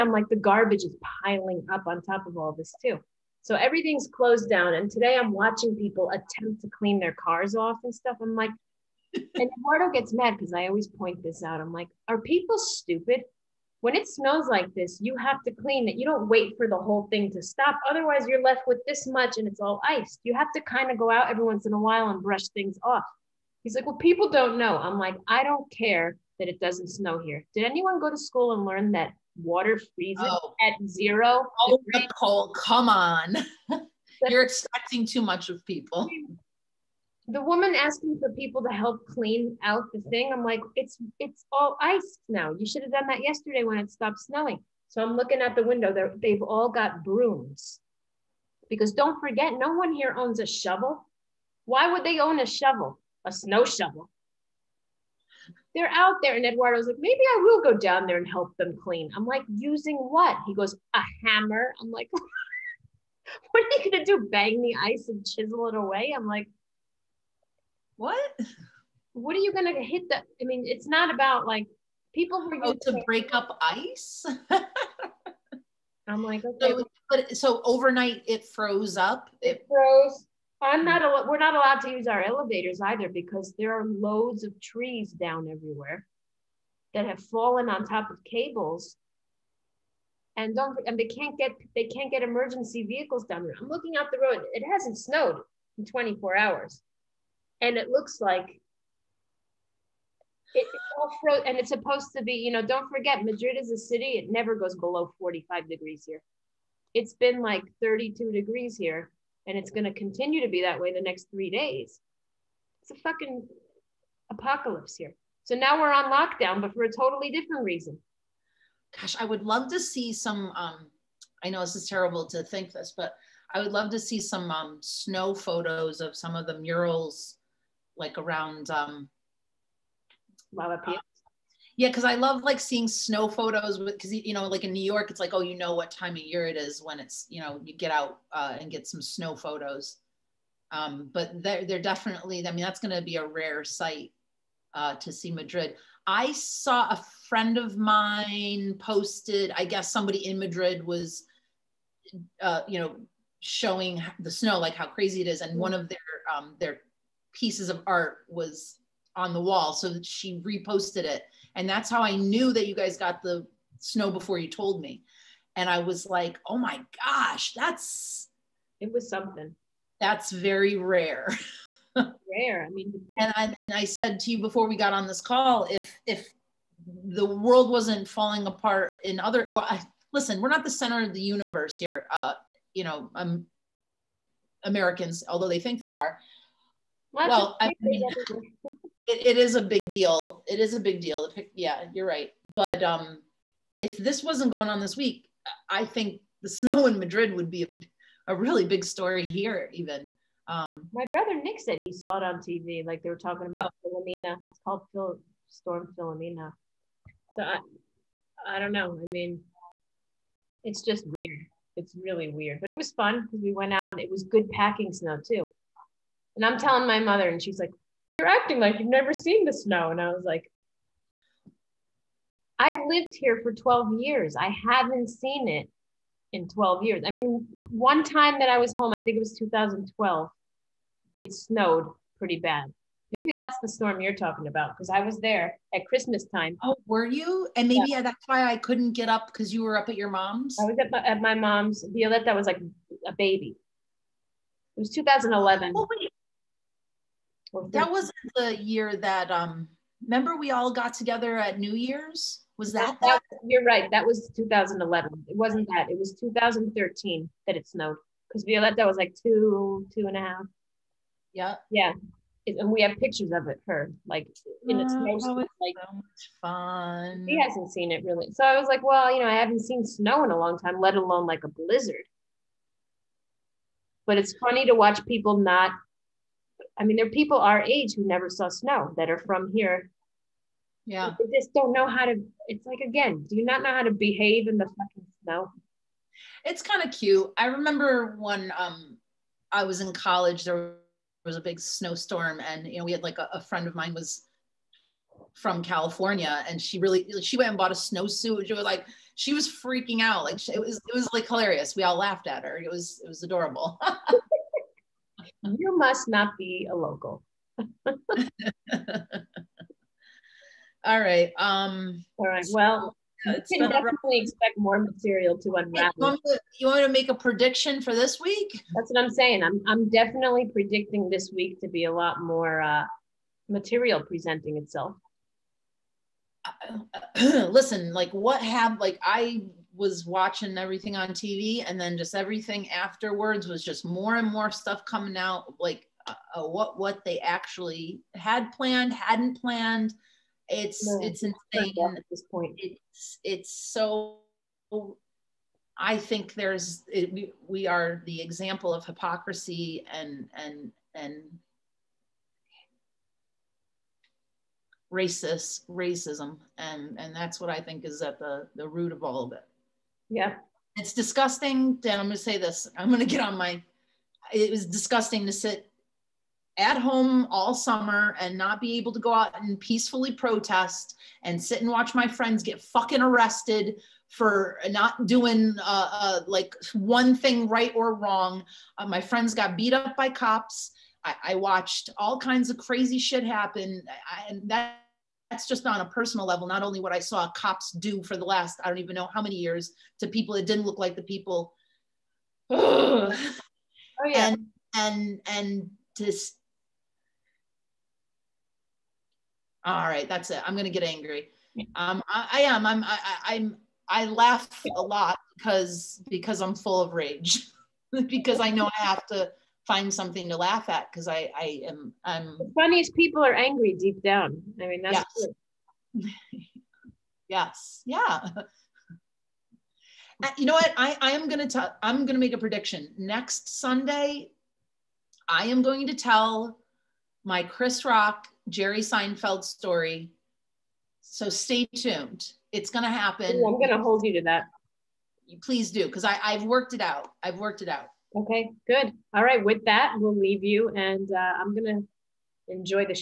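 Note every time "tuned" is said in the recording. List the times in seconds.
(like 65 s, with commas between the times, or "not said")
431 s.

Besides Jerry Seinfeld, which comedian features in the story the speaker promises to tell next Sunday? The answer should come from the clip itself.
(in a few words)
Chris Rock.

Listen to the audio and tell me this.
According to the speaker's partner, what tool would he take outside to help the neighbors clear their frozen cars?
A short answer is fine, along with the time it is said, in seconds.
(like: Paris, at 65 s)
A hammer, at 60 s.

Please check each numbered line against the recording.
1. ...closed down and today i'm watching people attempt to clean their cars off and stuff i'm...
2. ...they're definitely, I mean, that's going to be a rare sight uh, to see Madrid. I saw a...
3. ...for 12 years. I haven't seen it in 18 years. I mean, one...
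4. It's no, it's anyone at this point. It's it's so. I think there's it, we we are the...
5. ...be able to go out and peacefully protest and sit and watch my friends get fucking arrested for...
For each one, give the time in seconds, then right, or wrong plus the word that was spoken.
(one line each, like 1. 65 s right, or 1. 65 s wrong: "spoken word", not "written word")
1. 4 s right
2. 141 s right
3. 223 s wrong: "12", not "18"
4. 340 s wrong: "insane", not "anyone"
5. 368 s right.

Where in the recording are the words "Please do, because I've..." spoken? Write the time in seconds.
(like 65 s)
435 s.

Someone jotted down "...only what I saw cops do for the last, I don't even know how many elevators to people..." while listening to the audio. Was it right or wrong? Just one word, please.
wrong.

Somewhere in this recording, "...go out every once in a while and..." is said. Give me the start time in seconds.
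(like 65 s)
20 s.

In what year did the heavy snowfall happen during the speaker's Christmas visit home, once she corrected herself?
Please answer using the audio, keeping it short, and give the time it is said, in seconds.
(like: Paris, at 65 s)
2013, at 256 s.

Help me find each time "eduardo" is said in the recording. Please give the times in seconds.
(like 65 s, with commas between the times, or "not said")
9 s, 56 s.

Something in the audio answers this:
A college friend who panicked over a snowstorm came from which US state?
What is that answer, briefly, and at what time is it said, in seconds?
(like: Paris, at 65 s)
California, at 295 s.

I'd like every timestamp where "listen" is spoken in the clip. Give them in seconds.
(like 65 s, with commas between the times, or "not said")
180 s, 327 s.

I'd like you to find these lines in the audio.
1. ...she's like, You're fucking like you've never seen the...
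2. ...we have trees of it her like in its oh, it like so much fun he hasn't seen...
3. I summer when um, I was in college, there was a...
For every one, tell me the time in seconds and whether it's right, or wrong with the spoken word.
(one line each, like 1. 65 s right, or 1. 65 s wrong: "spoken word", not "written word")
1. 217 s wrong: "acting", not "fucking"
2. 262 s wrong: "pictures", not "trees"
3. 287 s wrong: "remember", not "summer".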